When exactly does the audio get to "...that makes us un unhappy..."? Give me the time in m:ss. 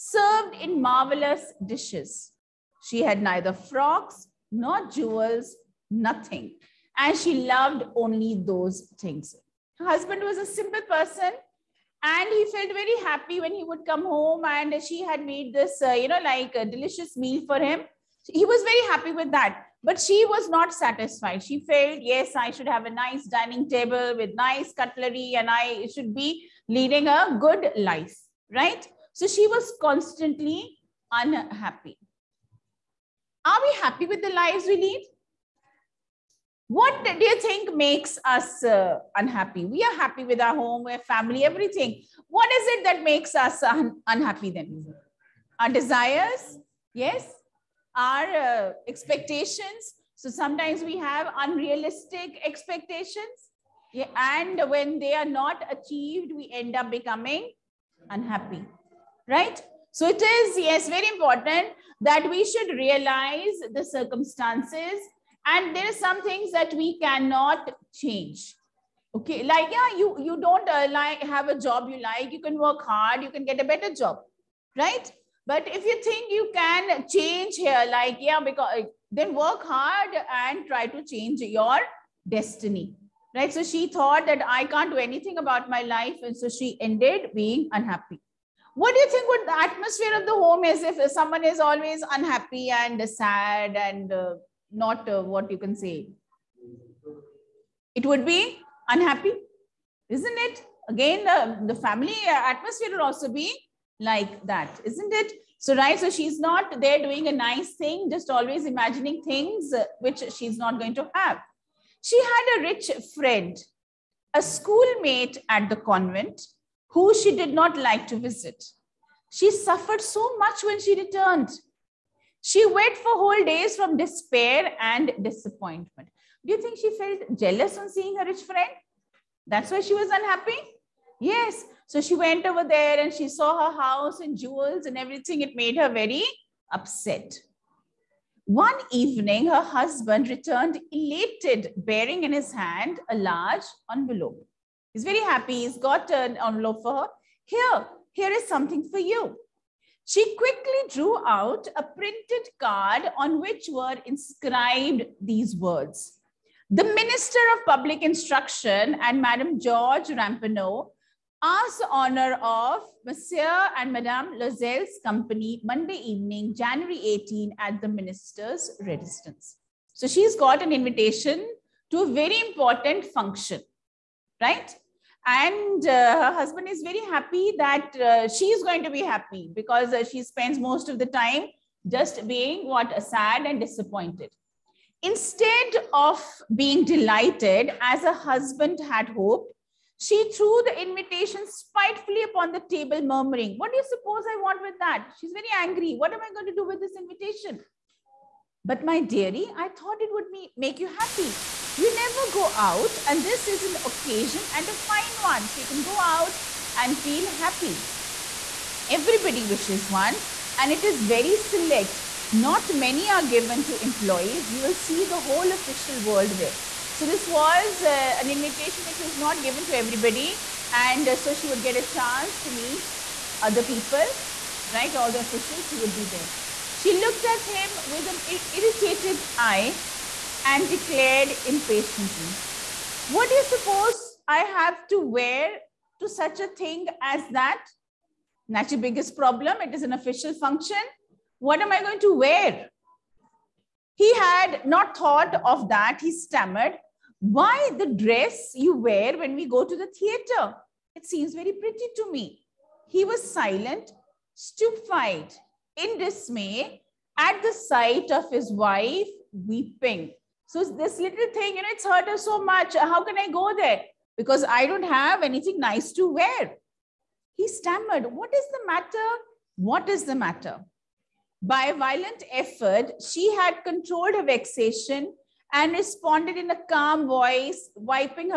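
0:42.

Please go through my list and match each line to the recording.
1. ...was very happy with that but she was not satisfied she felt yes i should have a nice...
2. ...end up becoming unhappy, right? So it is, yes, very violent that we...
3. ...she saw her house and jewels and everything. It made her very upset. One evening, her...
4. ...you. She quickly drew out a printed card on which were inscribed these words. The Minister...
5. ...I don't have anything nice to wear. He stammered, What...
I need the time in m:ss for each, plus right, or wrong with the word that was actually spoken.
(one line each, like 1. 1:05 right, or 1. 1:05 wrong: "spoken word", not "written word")
1. 0:18 right
2. 0:56 wrong: "important", not "violent"
3. 2:13 right
4. 2:28 right
5. 4:24 right.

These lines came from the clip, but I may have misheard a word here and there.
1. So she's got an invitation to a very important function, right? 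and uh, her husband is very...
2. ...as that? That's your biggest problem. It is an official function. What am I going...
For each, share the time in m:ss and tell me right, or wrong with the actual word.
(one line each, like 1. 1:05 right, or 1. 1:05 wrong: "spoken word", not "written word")
1. 2:49 right
2. 3:57 right.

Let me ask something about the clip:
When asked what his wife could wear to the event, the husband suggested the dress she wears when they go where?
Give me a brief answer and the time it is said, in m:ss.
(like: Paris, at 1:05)
the theater, at 4:09.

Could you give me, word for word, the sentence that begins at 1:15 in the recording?
But if you think you can change here, like, yeah, because uh, then work hard and try to change your destiny, right?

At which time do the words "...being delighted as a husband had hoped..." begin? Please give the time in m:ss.
3:06.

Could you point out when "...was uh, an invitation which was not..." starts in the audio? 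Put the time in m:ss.
3:37.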